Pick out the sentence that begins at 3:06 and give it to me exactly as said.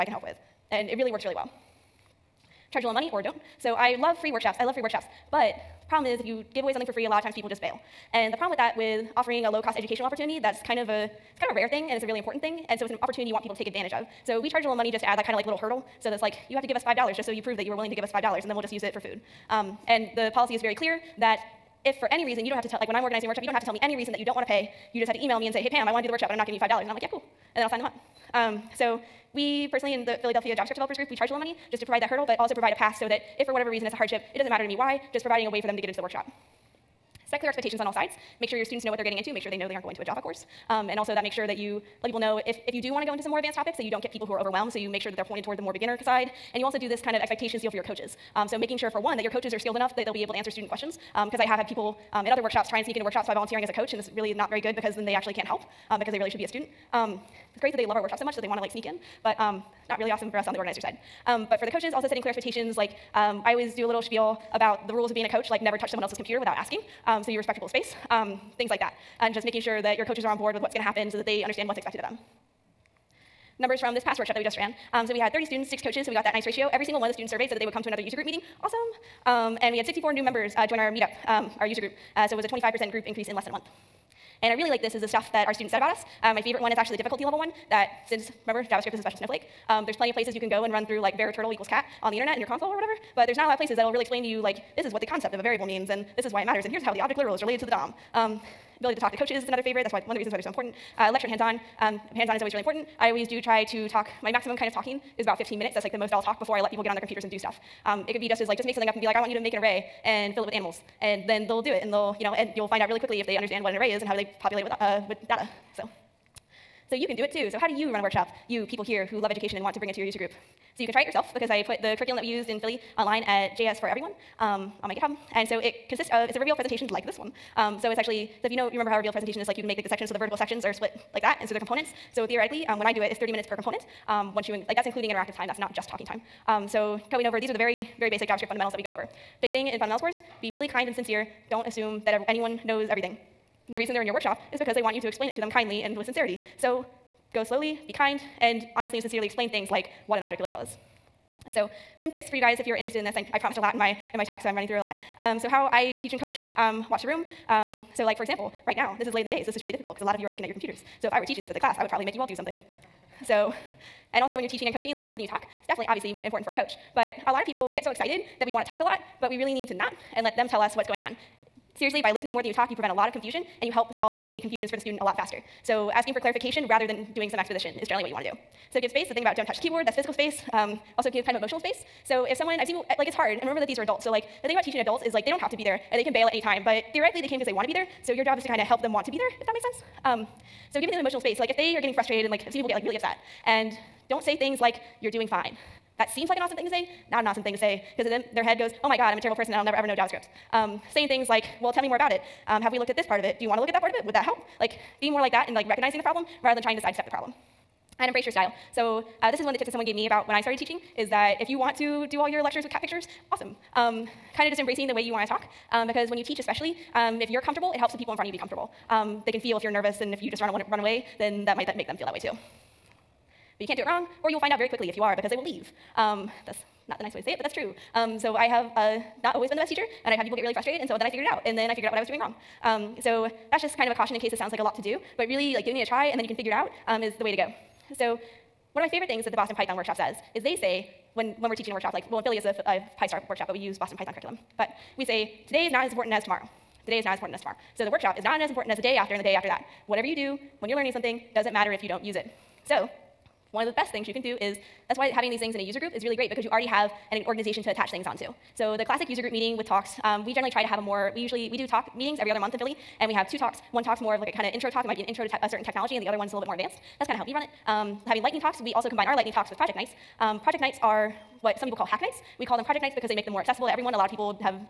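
But theoretically, they came because they want to be there.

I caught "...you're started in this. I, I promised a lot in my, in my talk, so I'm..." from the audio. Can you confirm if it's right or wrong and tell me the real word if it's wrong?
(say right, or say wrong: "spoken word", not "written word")
wrong: "interested", not "started".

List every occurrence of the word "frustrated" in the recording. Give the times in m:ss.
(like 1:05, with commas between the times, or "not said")
3:11, 3:50.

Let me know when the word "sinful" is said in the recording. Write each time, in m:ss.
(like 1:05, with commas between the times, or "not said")
not said.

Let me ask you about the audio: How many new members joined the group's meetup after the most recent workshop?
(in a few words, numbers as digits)
64.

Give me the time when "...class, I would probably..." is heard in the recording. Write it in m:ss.
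2:41.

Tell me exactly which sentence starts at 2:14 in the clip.
Um, once you, in, like that's including interactive time, that's not just talking time.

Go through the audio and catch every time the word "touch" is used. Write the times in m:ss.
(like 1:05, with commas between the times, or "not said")
1:05, 2:59.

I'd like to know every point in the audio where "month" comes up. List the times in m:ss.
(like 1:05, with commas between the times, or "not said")
1:23, 4:22.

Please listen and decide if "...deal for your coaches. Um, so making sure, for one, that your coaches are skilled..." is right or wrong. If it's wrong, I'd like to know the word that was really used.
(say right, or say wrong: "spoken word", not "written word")
right.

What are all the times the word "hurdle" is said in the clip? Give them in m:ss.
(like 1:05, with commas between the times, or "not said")
0:15, 0:32.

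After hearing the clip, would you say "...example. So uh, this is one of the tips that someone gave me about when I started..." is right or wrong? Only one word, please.
wrong.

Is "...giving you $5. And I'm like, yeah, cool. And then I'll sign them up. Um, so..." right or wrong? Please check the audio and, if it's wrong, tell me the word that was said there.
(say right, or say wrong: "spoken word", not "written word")
right.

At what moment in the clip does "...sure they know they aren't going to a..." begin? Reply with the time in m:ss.
0:39.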